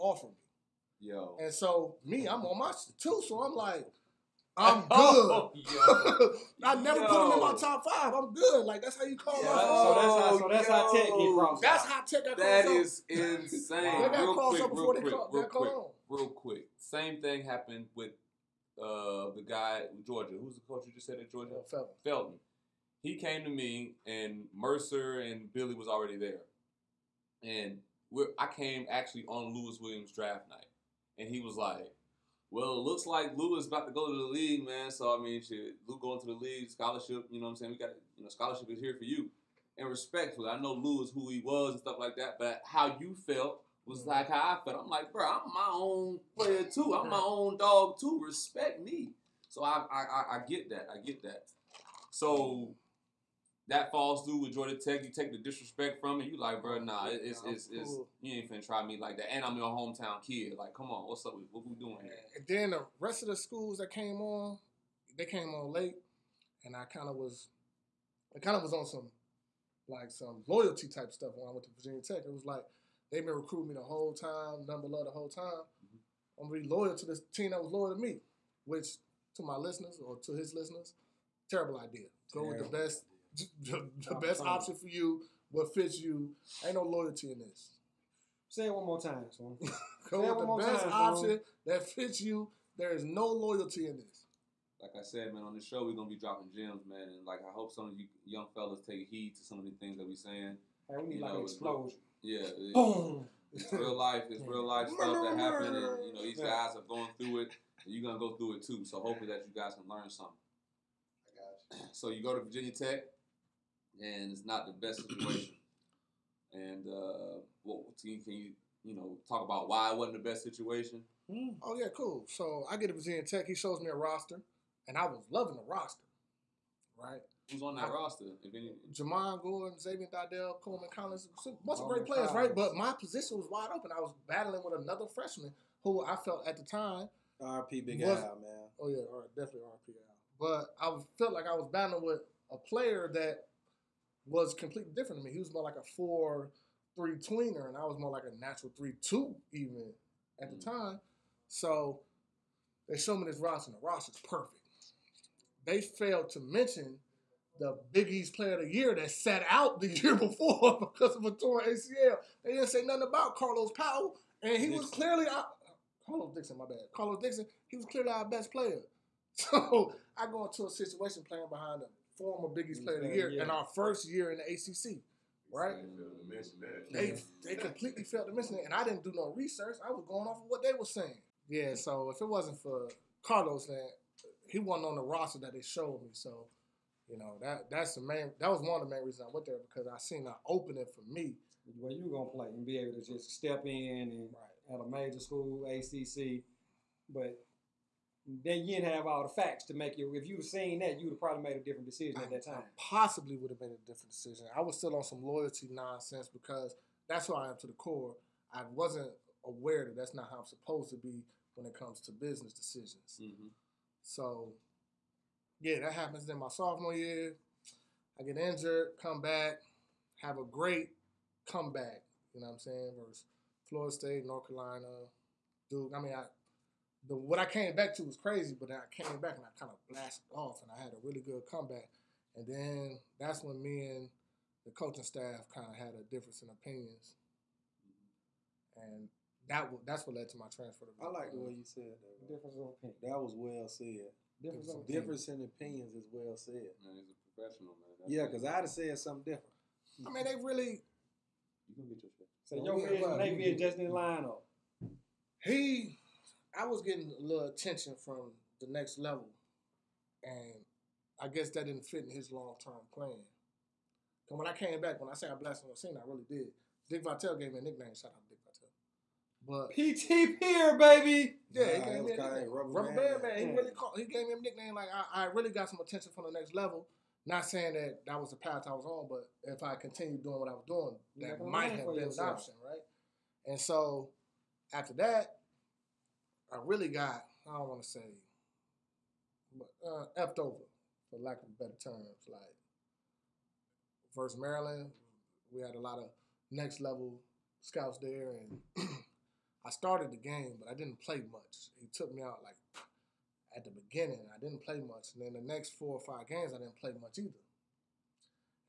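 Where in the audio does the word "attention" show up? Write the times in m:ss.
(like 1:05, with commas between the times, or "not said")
4:17, 4:35.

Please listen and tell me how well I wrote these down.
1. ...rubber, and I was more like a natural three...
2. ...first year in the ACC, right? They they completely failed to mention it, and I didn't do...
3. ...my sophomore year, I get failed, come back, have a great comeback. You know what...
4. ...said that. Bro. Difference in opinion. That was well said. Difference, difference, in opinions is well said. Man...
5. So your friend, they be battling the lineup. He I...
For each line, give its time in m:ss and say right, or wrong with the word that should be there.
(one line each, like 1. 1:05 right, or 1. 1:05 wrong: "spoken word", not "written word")
1. 2:27 wrong: "tweener", not "rubber"
2. 2:53 right
3. 3:36 wrong: "injured", not "failed"
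4. 4:01 right
5. 4:12 wrong: "adjusting", not "battling".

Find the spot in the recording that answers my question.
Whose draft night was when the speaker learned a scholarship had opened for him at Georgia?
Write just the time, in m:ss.
0:29.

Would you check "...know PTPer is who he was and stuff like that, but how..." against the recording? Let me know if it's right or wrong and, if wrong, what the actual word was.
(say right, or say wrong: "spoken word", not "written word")
wrong: "Lou", not "PTPer".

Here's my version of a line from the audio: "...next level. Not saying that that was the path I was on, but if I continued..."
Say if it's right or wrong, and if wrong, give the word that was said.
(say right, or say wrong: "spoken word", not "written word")
right.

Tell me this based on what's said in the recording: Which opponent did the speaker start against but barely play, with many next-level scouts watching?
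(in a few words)
Maryland.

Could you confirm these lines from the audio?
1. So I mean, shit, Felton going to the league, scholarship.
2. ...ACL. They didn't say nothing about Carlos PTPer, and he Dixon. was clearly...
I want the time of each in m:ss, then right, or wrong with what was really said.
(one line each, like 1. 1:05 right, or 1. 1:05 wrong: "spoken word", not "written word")
1. 0:34 wrong: "Lou", not "Felton"
2. 2:41 wrong: "Powell", not "PTPer".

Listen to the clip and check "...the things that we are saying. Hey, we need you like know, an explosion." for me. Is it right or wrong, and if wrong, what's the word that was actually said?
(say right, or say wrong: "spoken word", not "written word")
right.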